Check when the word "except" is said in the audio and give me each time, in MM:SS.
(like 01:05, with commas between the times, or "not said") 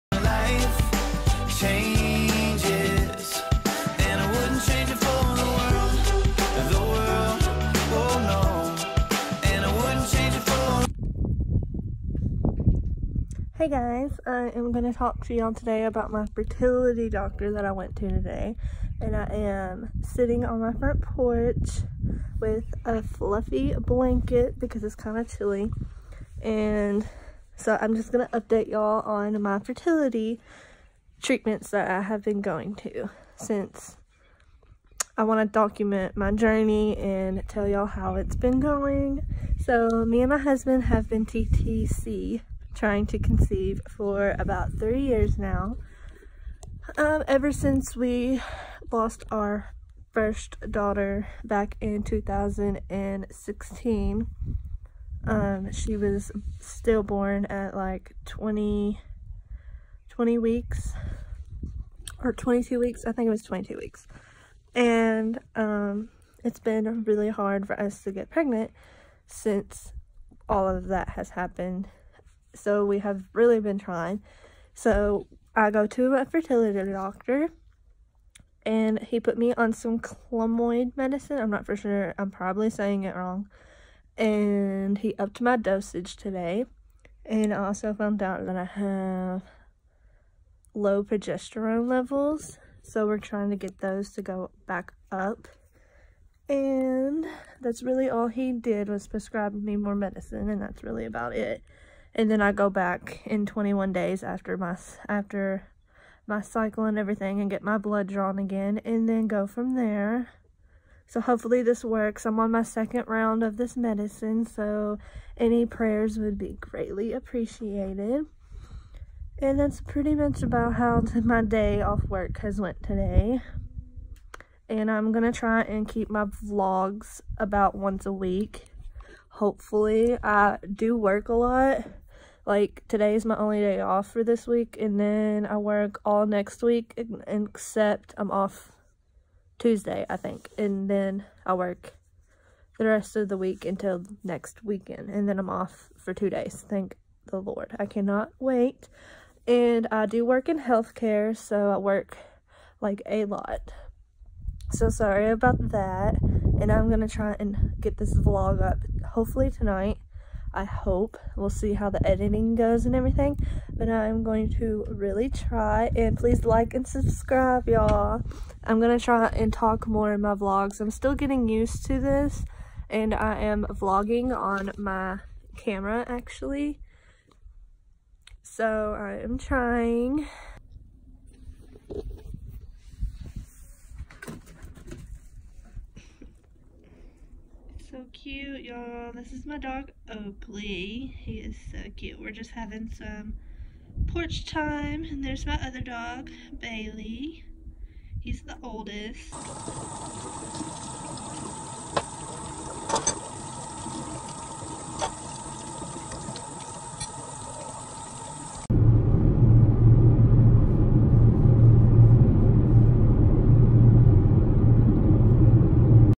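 02:17.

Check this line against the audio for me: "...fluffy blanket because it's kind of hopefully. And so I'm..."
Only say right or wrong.
wrong.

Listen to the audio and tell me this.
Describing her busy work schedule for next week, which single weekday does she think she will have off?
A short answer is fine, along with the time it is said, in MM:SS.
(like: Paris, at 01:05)
Tuesday, at 02:19.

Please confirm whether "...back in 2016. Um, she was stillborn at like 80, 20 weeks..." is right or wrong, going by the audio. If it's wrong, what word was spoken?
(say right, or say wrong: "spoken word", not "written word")
wrong: "20", not "80".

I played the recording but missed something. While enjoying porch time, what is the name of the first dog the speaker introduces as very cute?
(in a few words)
Oakley.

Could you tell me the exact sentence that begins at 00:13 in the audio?
Hey guys, I am going to talk to y'all today about my fertility doctor that I went to today.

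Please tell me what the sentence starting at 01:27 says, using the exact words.
And I also found out that I have low progesterone levels.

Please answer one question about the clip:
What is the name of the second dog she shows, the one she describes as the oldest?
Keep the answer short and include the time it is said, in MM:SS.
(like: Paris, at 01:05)
Bailey, at 03:16.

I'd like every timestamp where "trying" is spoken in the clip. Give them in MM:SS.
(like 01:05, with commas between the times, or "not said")
00:42, 01:13, 01:33, 02:59.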